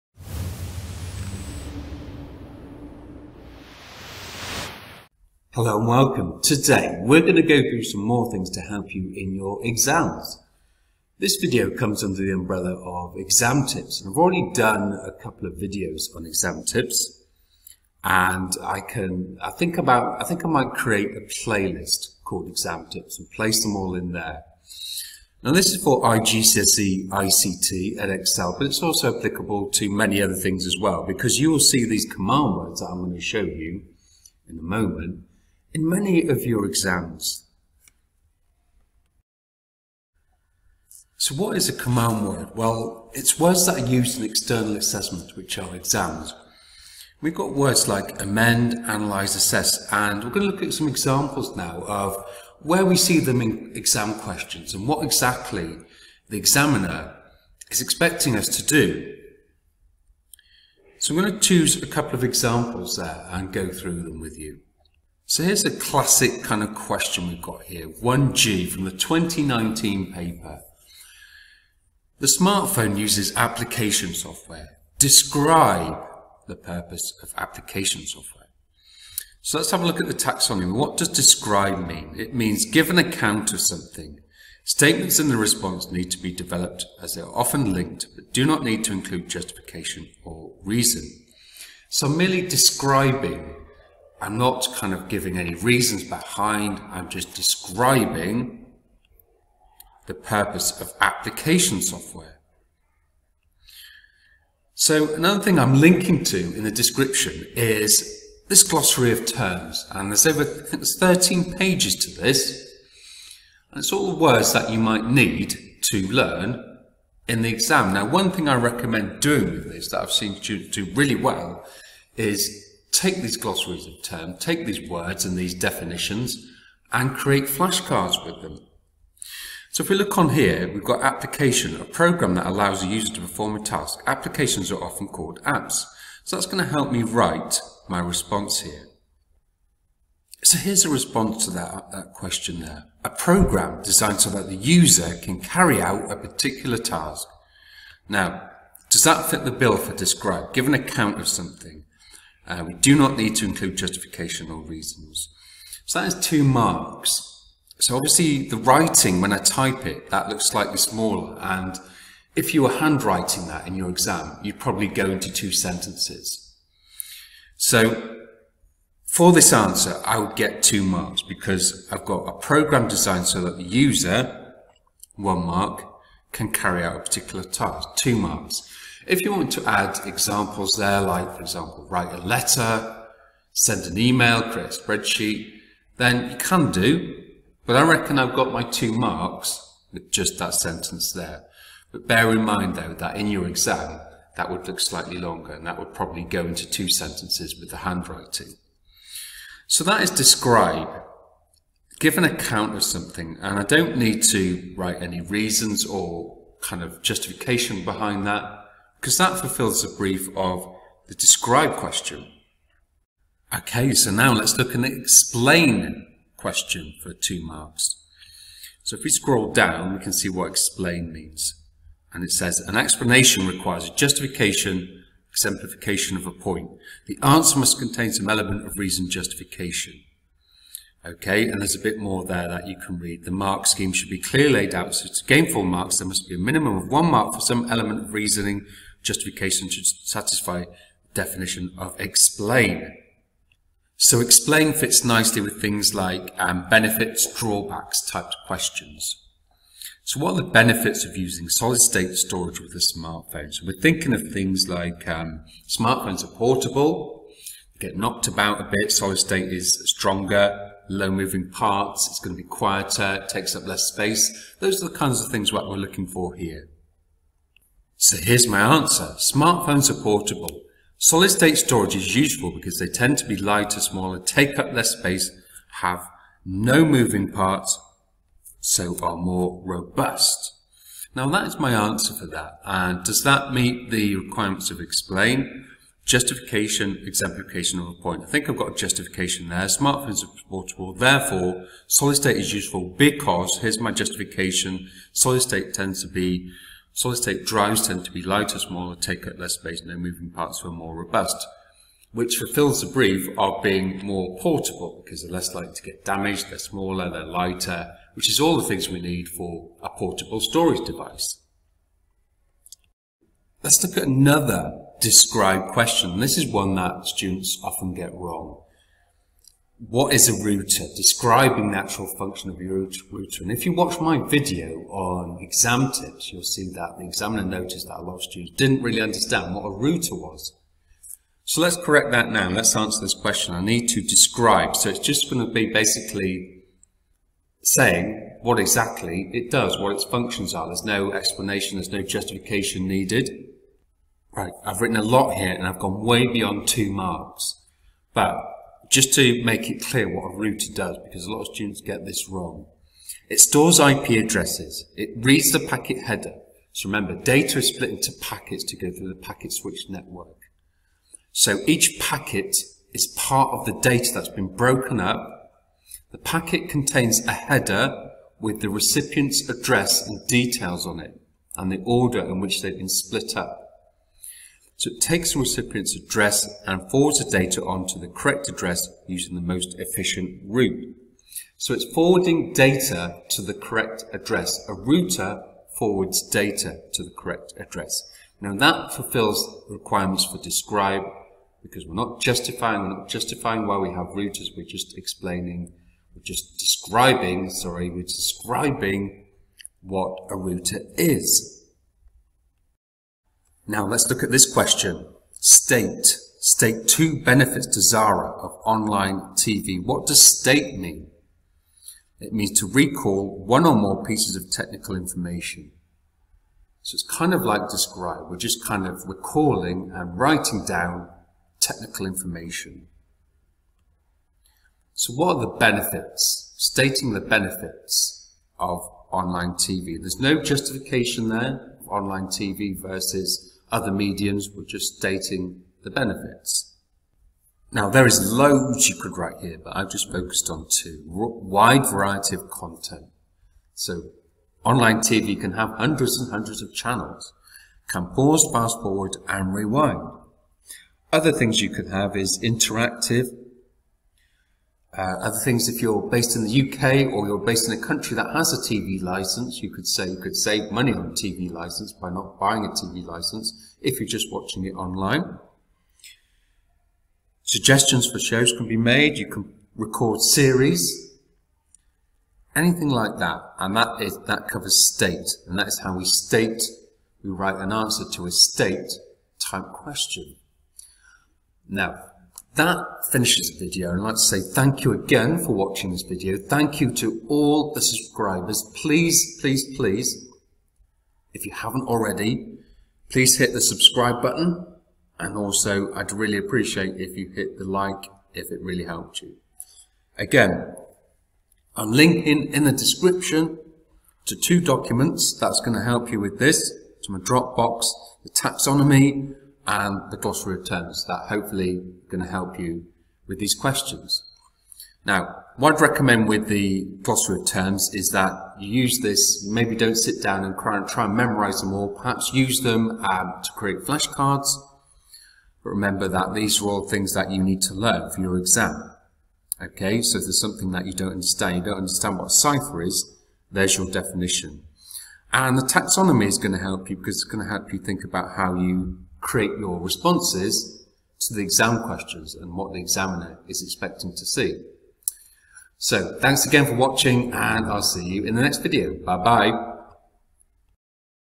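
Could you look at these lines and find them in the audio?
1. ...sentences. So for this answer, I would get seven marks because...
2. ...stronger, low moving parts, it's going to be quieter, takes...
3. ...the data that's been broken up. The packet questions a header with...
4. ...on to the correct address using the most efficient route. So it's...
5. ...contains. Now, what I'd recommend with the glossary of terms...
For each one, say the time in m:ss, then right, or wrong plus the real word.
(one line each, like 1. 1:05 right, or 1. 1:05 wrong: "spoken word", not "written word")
1. 2:45 wrong: "two", not "seven"
2. 4:19 right
3. 6:03 wrong: "contains", not "questions"
4. 6:17 right
5. 8:33 wrong: "questions", not "contains".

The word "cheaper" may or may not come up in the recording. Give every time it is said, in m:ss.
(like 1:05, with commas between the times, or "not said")
not said.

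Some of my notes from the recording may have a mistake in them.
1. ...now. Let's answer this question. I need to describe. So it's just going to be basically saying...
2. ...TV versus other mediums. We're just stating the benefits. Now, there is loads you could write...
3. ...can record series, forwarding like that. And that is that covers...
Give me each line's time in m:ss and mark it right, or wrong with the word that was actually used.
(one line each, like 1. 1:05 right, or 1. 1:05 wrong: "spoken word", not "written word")
1. 5:32 right
2. 7:12 right
3. 7:49 wrong: "anything", not "forwarding".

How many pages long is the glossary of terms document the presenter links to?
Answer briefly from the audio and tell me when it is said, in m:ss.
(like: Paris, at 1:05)
13, at 1:50.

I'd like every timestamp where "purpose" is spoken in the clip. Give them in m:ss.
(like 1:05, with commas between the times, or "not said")
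1:16, 1:40.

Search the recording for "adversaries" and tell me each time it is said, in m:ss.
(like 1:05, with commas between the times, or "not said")
not said.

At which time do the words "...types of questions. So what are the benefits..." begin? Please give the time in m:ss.
4:08.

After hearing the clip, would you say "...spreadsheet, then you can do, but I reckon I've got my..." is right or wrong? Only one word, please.
right.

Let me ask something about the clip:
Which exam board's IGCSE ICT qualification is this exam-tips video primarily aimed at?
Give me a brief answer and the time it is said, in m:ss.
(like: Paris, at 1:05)
Edexcel, at 0:27.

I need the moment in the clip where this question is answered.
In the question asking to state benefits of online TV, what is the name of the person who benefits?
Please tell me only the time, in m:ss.
6:47.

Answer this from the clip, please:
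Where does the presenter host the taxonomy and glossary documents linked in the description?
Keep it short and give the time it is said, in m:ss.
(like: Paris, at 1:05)
Dropbox, at 8:27.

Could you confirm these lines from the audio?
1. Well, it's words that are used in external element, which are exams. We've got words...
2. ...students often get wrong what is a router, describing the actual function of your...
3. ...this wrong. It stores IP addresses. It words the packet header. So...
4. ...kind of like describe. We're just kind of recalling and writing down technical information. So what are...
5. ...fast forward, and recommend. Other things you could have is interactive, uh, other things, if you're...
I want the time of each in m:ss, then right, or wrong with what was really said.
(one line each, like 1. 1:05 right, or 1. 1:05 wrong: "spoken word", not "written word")
1. 0:42 wrong: "assessment", not "element"
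2. 5:17 right
3. 5:52 wrong: "reads", not "words"
4. 6:57 right
5. 7:28 wrong: "rewind", not "recommend".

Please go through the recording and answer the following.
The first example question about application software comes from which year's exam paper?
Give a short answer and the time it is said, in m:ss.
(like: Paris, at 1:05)
2019, at 1:08.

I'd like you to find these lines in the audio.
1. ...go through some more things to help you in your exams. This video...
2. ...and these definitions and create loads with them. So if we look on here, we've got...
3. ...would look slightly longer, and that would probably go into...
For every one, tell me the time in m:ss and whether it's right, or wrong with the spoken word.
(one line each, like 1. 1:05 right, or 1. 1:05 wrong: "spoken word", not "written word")
1. 0:07 right
2. 2:05 wrong: "flashcards", not "loads"
3. 3:14 right.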